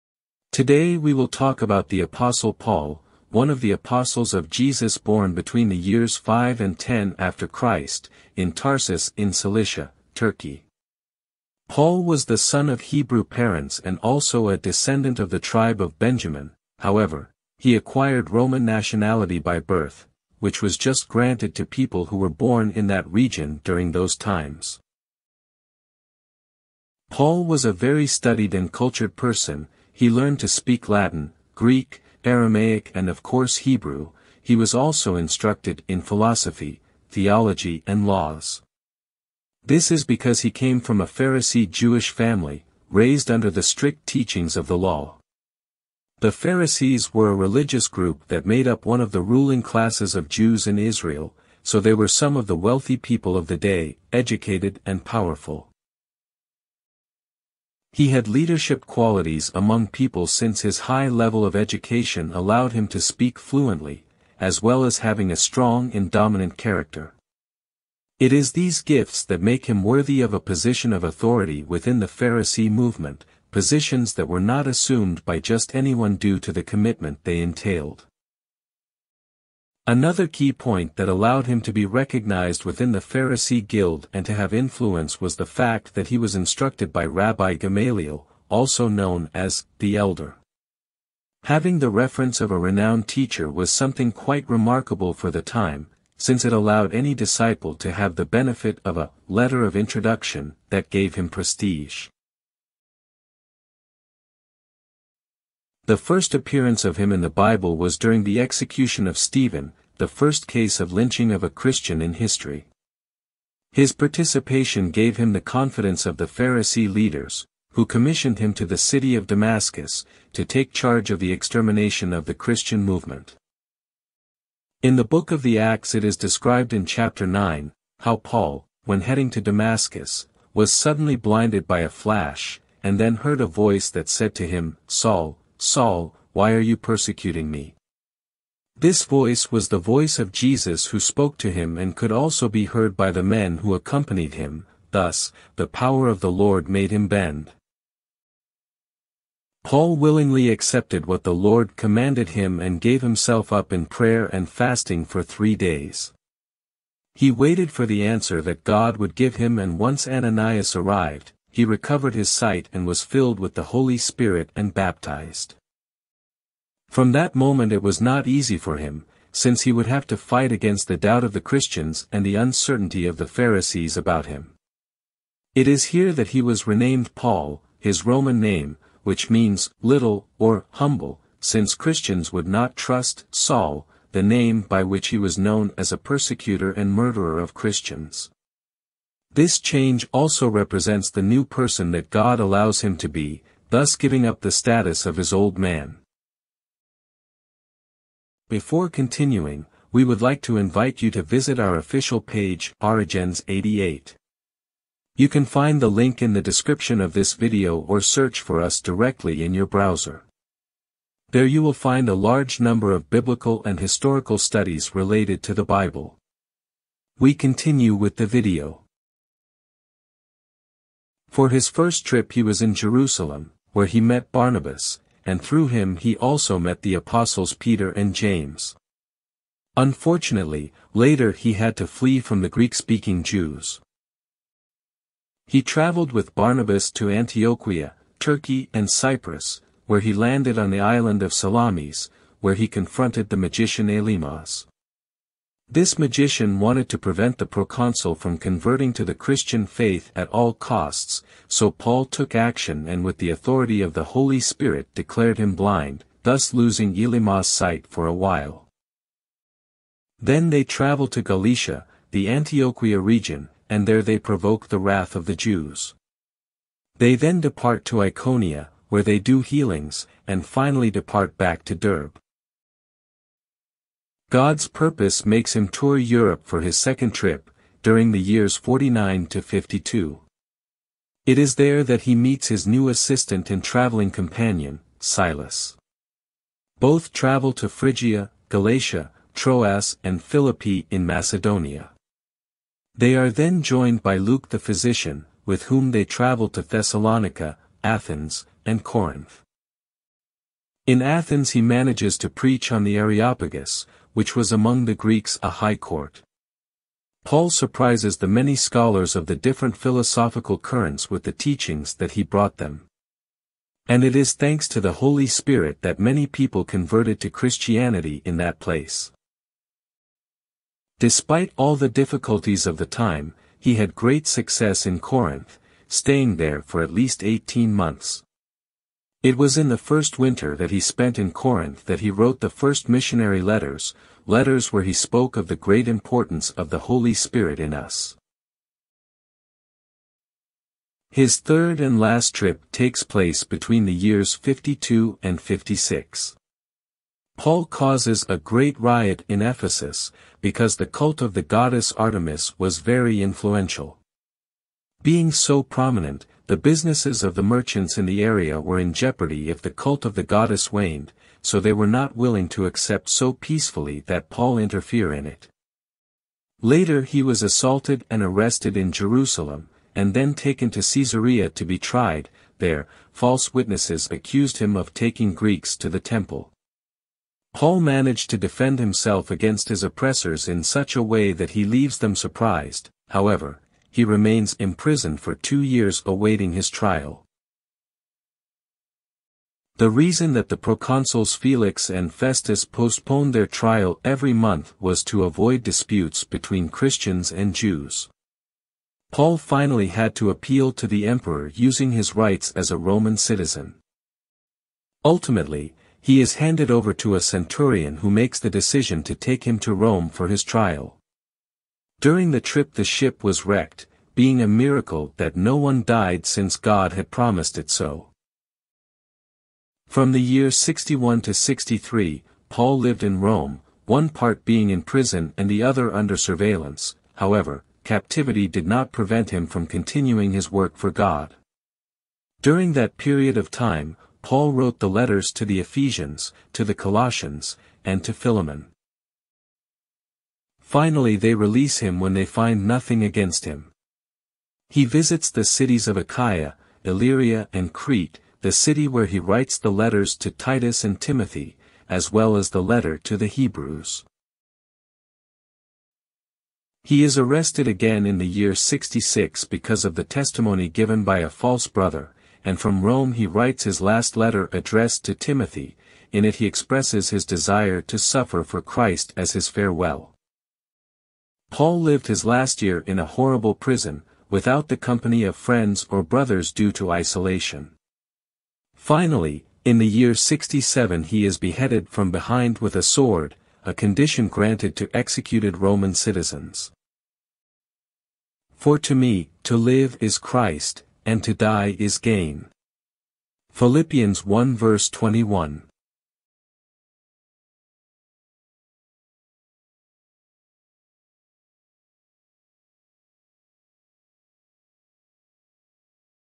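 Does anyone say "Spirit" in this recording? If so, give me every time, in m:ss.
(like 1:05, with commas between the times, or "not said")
2:43, 4:14, 5:15, 5:37.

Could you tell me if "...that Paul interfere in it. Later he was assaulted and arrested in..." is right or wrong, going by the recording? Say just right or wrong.
right.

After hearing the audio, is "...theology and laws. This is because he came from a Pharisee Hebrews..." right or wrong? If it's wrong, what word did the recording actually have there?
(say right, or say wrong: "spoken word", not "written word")
wrong: "Jewish", not "Hebrews".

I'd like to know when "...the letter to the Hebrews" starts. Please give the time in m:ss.
7:32.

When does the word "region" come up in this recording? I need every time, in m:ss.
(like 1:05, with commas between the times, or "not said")
0:23, 4:22.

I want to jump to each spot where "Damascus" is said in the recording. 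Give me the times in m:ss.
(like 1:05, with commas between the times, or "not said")
1:59, 2:09.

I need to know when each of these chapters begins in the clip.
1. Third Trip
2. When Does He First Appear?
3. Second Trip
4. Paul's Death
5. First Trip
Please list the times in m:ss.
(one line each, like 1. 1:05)
1. 5:39
2. 1:43
3. 4:33
4. 7:35
5. 3:40.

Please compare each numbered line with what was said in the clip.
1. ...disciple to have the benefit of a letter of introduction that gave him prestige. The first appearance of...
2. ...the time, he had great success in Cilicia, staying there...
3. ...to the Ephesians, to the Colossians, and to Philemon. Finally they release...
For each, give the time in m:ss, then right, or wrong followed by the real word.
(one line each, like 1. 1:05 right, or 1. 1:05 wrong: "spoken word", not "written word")
1. 1:37 right
2. 5:22 wrong: "Corinth", not "Cilicia"
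3. 7:15 right.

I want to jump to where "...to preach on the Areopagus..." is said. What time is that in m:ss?
5:02.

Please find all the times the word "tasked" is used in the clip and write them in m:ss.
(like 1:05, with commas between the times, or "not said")
not said.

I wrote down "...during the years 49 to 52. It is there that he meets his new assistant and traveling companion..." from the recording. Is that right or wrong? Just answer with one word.
right.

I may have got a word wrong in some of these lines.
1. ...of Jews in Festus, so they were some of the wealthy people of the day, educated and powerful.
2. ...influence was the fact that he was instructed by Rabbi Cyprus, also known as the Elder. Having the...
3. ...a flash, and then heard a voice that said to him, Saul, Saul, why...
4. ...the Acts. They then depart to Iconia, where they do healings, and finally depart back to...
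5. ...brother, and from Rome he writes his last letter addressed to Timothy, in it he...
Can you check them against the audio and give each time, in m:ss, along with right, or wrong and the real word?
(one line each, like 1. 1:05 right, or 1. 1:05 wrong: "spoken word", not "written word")
1. 0:50 wrong: "Israel", not "Festus"
2. 1:24 wrong: "Gamaliel", not "Cyprus"
3. 2:11 right
4. 4:25 wrong: "Jews", not "Acts"
5. 7:41 right.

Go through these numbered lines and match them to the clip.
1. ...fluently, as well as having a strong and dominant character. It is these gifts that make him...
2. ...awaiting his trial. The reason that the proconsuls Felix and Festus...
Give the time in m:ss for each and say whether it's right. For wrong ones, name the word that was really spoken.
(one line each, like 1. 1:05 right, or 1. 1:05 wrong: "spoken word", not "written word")
1. 1:03 right
2. 6:26 right.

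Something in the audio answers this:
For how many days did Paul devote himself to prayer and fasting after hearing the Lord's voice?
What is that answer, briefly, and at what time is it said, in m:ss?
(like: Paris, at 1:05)
3, at 2:35.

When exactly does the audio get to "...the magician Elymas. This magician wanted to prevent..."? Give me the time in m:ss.
4:03.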